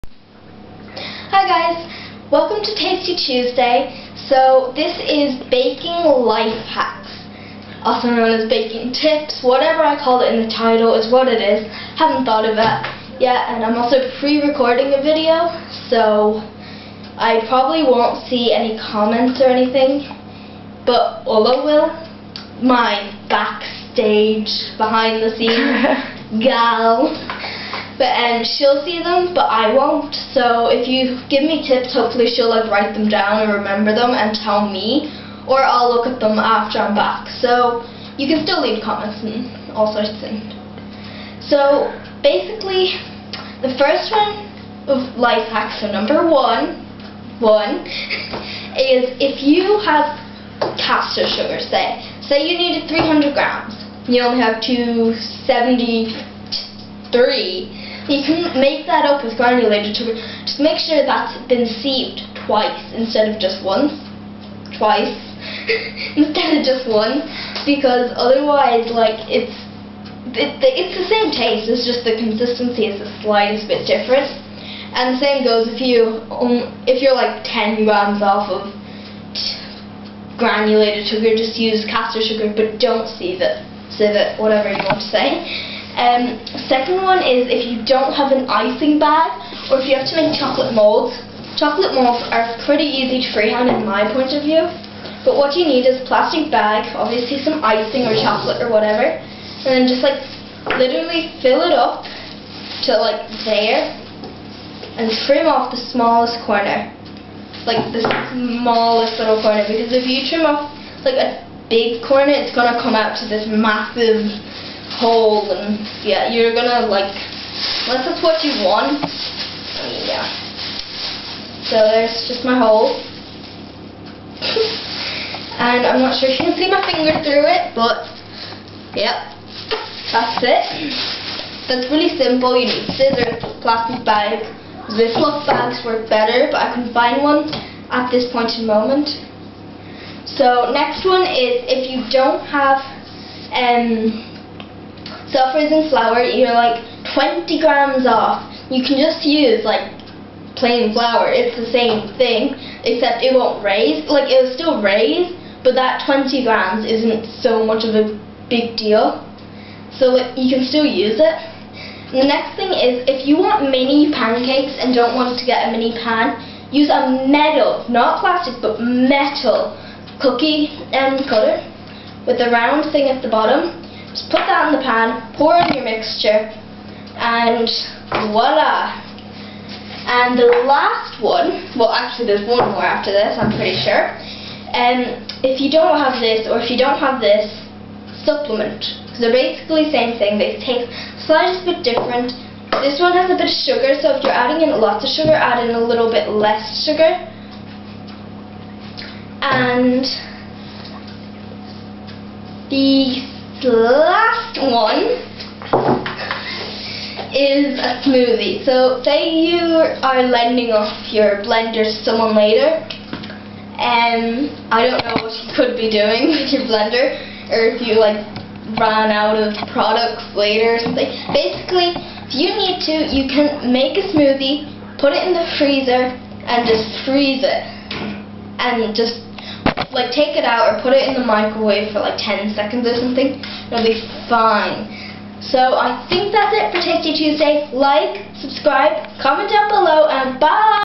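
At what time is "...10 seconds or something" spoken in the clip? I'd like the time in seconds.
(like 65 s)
232 s.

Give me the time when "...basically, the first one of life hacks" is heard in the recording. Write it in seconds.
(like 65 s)
42 s.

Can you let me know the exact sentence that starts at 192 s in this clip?
This one has a bit of sugar, so if you're adding in lots of sugar, add in a little bit less sugar.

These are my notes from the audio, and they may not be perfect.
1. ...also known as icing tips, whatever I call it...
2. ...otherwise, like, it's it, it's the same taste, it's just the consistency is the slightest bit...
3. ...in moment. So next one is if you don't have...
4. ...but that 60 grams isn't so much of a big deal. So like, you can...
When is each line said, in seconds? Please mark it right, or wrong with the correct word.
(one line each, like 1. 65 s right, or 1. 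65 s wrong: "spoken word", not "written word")
1. 7 s wrong: "baking", not "icing"
2. 68 s right
3. 138 s right
4. 155 s wrong: "20", not "60".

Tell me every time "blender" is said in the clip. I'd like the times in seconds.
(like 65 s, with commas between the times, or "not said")
211 s, 216 s.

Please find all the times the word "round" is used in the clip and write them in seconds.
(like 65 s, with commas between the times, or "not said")
172 s.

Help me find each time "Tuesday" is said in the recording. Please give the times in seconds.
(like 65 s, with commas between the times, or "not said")
3 s, 237 s.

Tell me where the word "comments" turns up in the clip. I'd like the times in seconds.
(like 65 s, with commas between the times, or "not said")
18 s, 38 s, 239 s.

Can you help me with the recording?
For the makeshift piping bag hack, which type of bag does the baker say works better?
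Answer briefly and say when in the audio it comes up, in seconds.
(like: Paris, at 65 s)
Ziploc bags, at 134 s.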